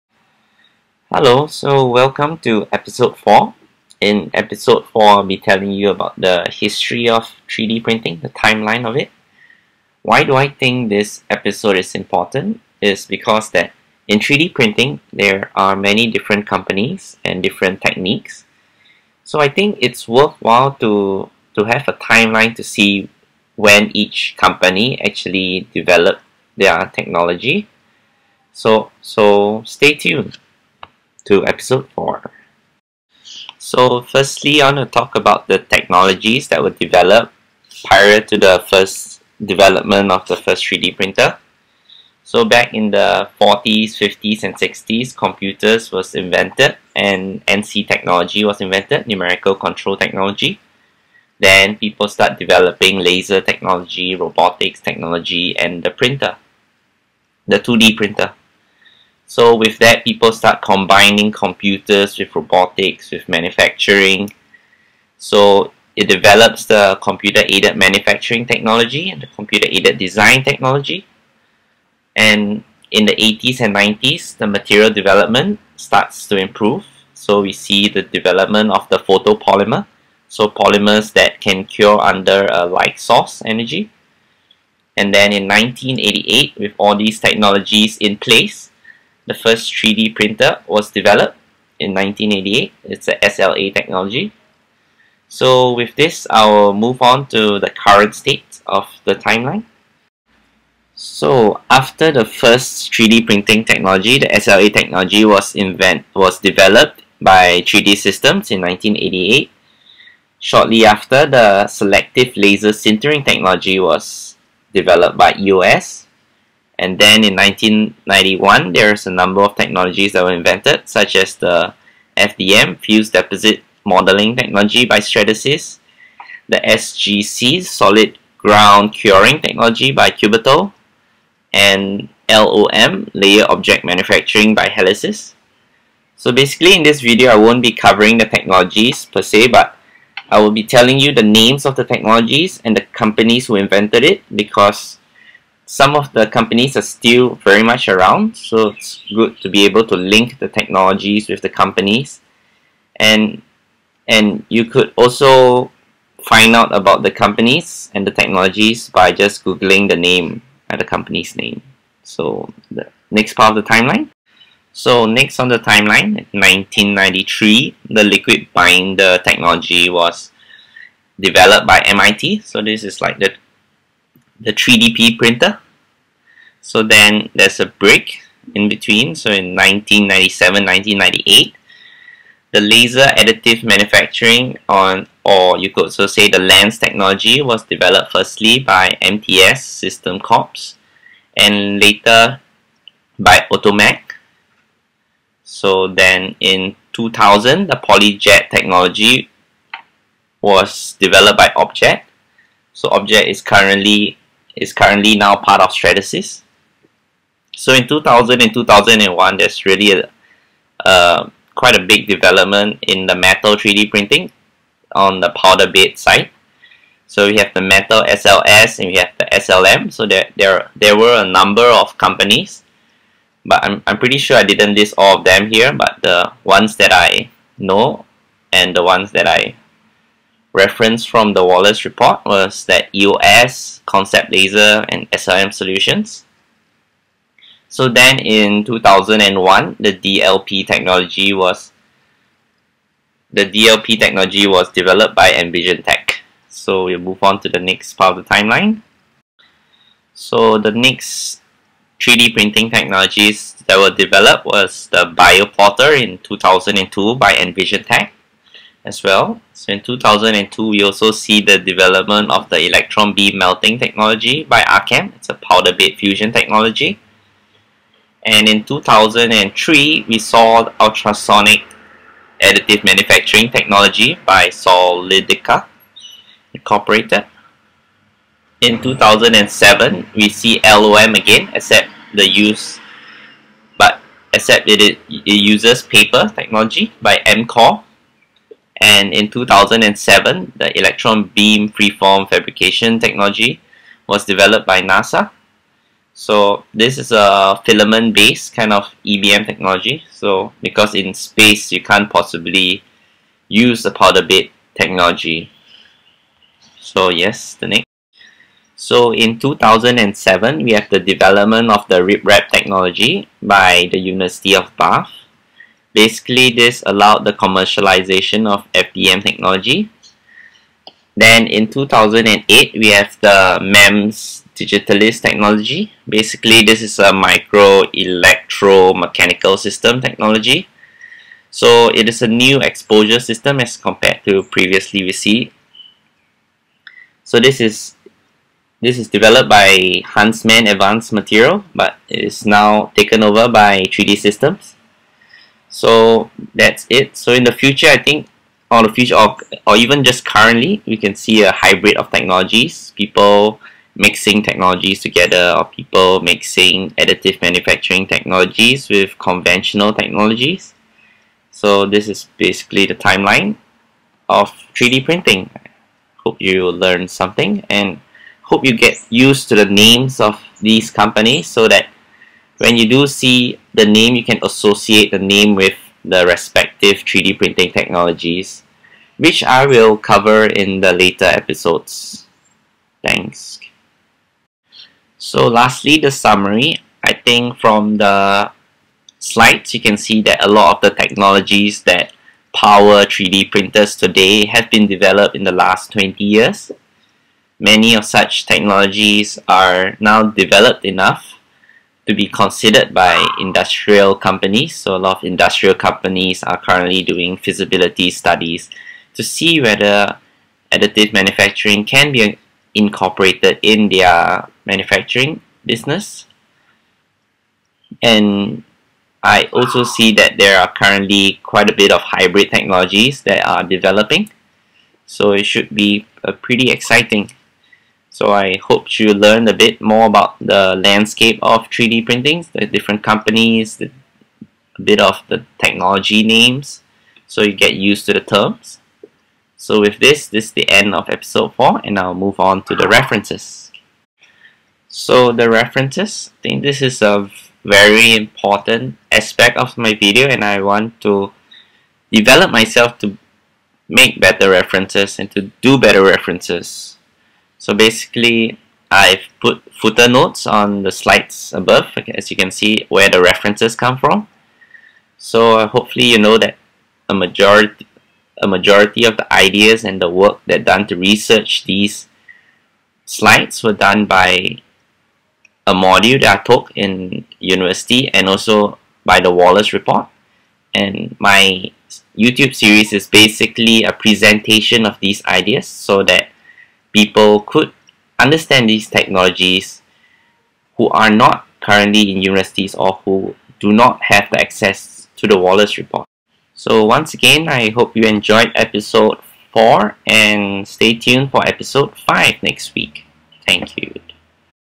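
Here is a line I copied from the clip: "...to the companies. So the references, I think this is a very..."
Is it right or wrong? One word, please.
wrong.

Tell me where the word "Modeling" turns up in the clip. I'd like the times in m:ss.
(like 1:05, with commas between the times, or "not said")
2:03.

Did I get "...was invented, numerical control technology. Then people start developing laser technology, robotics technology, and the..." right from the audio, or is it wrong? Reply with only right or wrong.
right.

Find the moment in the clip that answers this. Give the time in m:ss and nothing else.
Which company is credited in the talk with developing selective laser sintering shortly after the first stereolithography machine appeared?
1:55.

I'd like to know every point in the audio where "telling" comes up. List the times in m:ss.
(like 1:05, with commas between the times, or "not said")
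0:05, 2:20.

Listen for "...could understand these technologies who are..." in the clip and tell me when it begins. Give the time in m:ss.
8:07.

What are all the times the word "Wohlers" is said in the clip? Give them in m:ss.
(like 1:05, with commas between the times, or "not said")
3:51, 7:59, 8:15.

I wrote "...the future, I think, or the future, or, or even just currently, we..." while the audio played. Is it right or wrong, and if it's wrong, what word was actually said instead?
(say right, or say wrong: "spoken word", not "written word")
right.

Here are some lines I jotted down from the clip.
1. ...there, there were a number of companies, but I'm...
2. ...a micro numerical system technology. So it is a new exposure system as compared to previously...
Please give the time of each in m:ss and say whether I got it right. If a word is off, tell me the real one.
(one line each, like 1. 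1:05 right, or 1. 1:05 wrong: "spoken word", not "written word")
1. 3:40 right
2. 5:26 wrong: "electromechanical", not "numerical".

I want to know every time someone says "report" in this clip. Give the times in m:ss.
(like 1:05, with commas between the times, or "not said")
3:51, 7:59, 8:15.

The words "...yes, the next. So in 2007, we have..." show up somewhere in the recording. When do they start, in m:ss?
5:07.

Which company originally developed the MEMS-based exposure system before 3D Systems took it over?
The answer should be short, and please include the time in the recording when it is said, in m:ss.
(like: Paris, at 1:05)
Huntsman Advanced Material, at 5:40.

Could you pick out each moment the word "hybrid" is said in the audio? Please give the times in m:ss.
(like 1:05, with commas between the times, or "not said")
5:51, 7:02.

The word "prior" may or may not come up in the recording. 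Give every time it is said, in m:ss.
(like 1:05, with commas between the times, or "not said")
0:37.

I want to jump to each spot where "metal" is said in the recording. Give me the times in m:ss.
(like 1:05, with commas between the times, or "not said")
3:33, 3:37.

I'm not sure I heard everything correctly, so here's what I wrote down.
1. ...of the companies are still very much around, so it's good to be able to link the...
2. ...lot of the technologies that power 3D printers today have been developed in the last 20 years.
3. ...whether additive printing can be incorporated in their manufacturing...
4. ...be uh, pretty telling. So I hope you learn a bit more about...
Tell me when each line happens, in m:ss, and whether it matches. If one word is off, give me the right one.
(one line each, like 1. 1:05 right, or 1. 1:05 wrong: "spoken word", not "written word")
1. 2:25 right
2. 6:30 right
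3. 6:49 wrong: "manufacturing", not "printing"
4. 7:05 wrong: "exciting", not "telling".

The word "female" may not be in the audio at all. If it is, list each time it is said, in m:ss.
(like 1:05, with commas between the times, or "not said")
not said.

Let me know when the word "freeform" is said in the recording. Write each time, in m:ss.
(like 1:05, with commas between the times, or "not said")
4:51.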